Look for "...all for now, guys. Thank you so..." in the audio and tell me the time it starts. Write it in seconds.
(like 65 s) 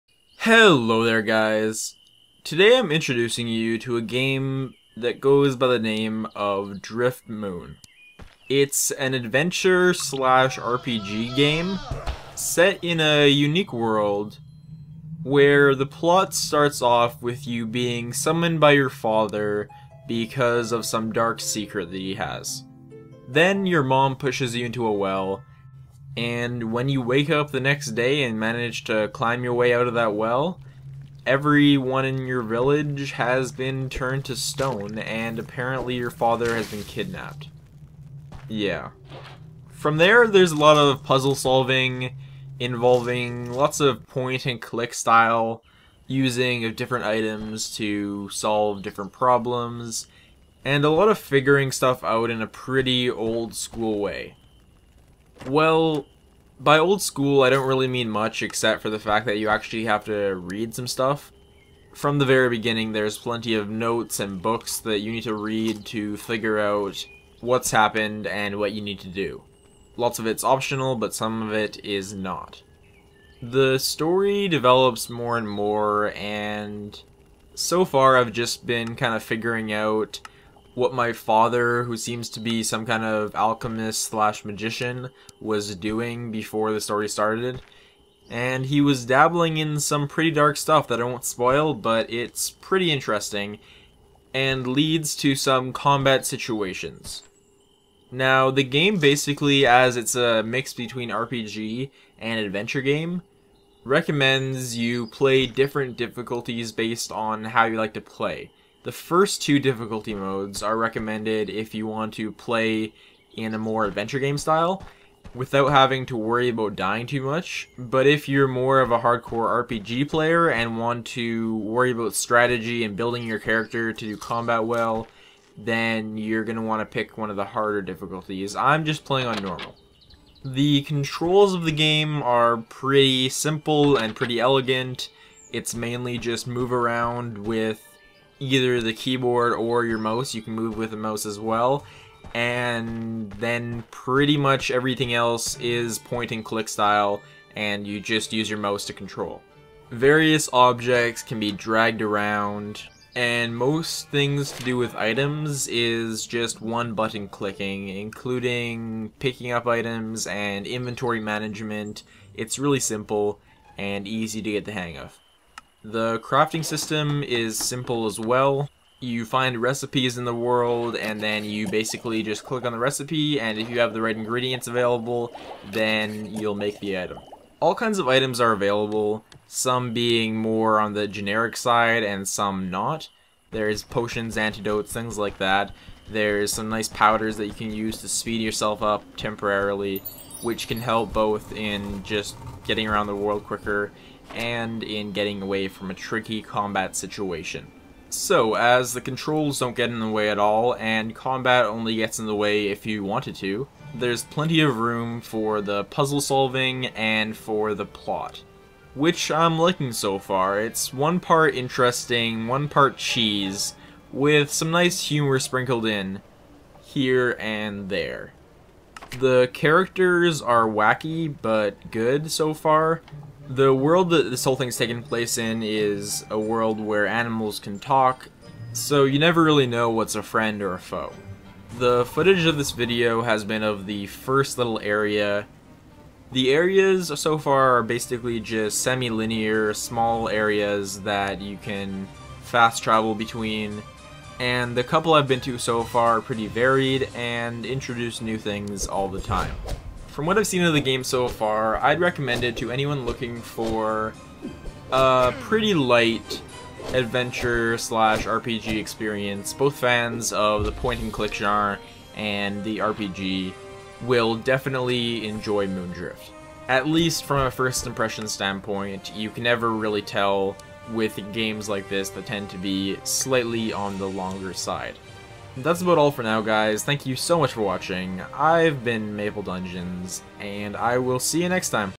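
275 s.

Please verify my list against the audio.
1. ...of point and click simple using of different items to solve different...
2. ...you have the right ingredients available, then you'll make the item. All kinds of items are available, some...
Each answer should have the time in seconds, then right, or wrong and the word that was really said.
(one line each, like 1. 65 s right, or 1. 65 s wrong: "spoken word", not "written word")
1. 43 s wrong: "style", not "simple"
2. 173 s right.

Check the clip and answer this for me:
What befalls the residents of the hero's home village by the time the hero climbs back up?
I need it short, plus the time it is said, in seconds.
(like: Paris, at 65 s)
Turned to stone, at 33 s.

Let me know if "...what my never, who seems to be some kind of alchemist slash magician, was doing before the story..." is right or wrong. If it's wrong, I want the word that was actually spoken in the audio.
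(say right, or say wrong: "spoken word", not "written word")
wrong: "father", not "never".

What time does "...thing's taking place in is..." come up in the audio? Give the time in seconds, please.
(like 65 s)
224 s.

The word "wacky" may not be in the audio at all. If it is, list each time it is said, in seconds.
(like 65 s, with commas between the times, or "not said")
220 s.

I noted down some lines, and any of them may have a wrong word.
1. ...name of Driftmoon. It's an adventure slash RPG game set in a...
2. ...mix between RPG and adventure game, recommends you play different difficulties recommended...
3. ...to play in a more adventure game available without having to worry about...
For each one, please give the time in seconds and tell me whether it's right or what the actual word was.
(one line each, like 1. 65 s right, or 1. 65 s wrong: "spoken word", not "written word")
1. 5 s right
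2. 100 s wrong: "based", not "recommended"
3. 112 s wrong: "style", not "available".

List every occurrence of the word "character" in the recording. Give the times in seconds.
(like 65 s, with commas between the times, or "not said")
123 s, 219 s.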